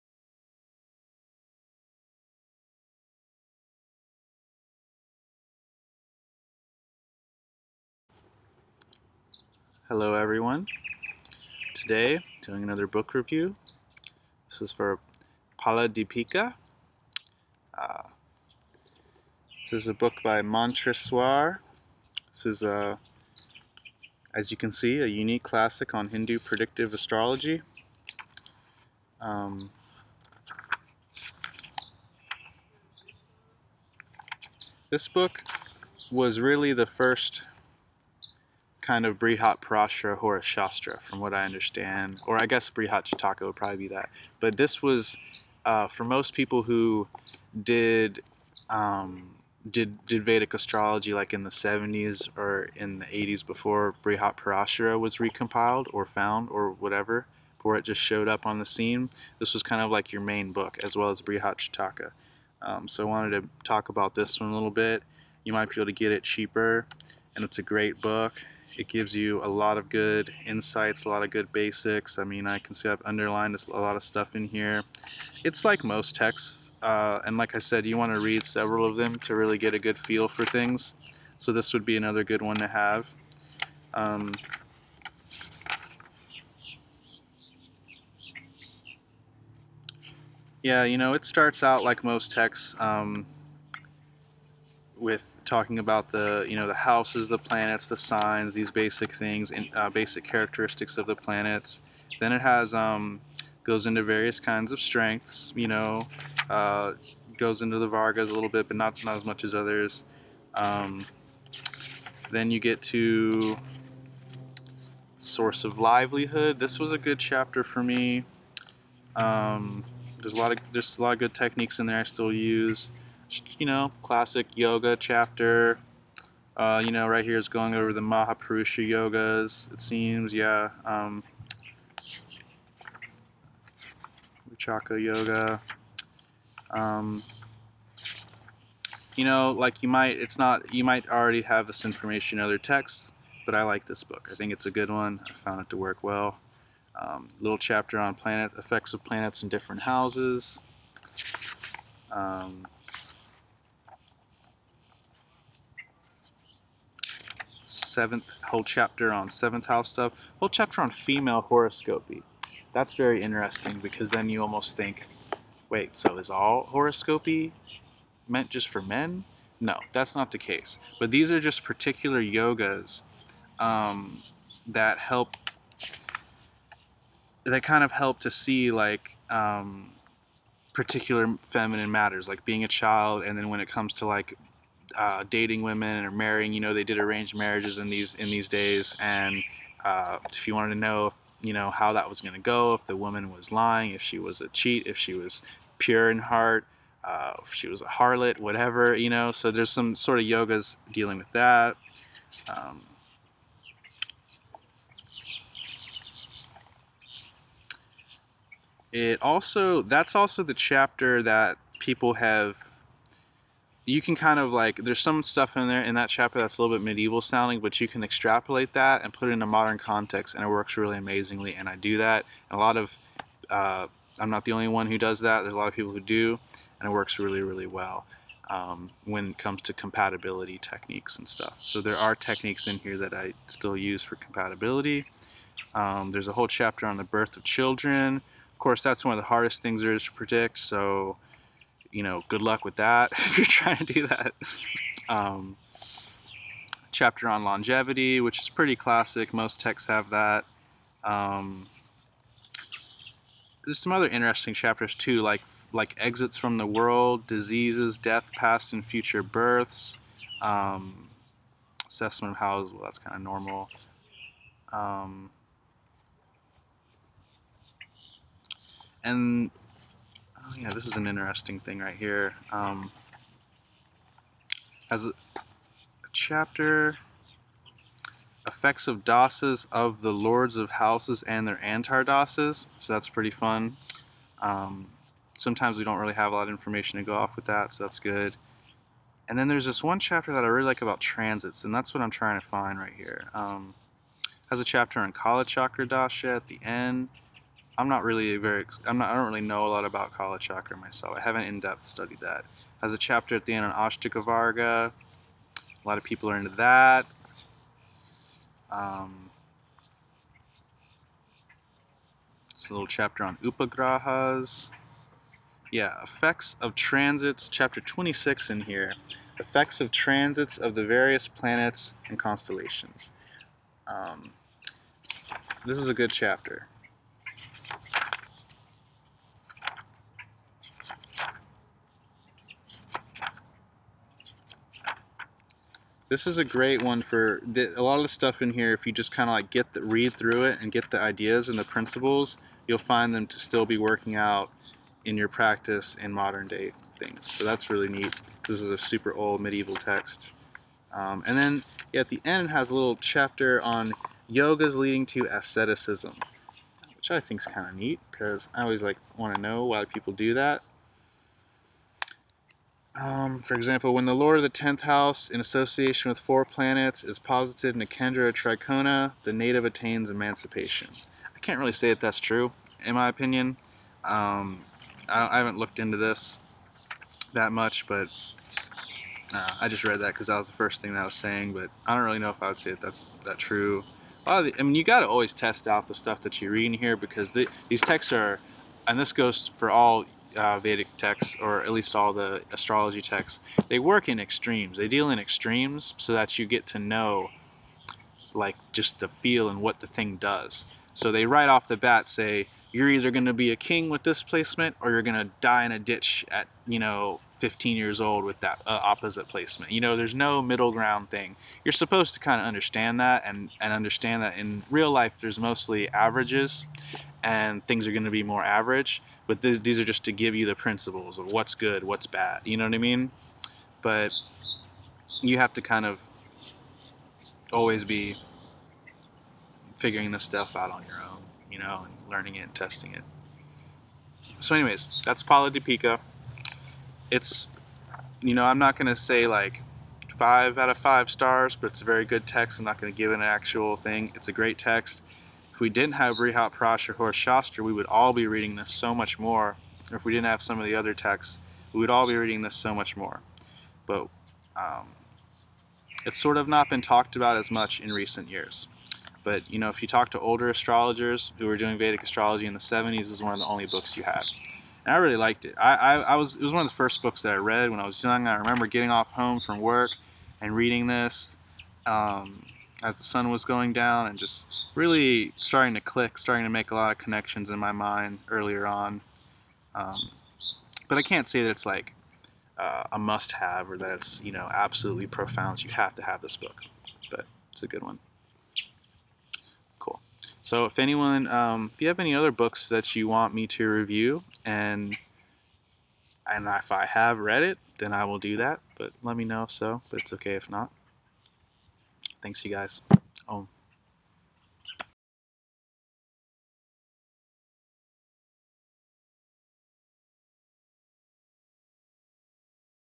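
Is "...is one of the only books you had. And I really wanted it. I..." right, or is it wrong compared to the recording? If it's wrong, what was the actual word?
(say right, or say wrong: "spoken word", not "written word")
wrong: "liked", not "wanted".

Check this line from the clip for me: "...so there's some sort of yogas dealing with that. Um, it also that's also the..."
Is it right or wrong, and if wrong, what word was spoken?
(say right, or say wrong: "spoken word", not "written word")
right.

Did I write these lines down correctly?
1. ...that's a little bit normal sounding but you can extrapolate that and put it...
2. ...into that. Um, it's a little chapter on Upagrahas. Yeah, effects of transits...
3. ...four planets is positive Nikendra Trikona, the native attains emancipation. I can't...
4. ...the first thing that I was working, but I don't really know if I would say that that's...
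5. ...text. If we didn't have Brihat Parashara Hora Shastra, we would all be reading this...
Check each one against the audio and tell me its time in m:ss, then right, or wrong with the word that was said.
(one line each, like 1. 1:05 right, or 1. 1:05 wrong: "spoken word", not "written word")
1. 3:36 wrong: "medieval", not "normal"
2. 5:06 right
3. 6:06 right
4. 6:20 wrong: "saying", not "working"
5. 7:24 right.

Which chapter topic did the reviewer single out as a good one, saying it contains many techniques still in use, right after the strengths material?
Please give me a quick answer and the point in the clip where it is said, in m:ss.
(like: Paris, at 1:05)
Source of livelihood, at 1:55.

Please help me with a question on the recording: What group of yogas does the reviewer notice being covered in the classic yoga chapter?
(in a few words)
Mahapurusha yogas.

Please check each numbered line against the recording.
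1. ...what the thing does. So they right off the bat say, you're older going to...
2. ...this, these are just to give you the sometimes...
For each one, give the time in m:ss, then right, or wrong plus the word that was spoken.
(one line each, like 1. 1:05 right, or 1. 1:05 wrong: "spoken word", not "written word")
1. 6:39 wrong: "either", not "older"
2. 6:59 wrong: "principles", not "sometimes".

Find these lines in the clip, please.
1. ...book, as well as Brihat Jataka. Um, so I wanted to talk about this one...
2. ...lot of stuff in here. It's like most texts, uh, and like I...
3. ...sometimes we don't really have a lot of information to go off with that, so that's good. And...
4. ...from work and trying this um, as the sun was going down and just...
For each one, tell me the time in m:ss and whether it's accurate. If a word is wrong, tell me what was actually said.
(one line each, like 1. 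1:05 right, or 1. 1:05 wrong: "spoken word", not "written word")
1. 1:00 right
2. 1:13 right
3. 4:45 right
4. 7:49 wrong: "reading", not "trying".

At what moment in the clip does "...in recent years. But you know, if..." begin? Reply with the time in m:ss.
7:37.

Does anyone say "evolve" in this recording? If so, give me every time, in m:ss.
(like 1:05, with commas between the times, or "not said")
not said.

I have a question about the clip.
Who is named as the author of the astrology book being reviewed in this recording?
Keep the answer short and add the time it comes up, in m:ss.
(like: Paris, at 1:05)
Mantreswara, at 0:20.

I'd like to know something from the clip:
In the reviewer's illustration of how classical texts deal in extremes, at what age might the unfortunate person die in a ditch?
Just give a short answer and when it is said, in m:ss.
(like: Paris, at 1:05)
15, at 6:47.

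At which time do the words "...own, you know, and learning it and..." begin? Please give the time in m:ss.
7:11.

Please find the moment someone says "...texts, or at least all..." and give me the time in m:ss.
6:30.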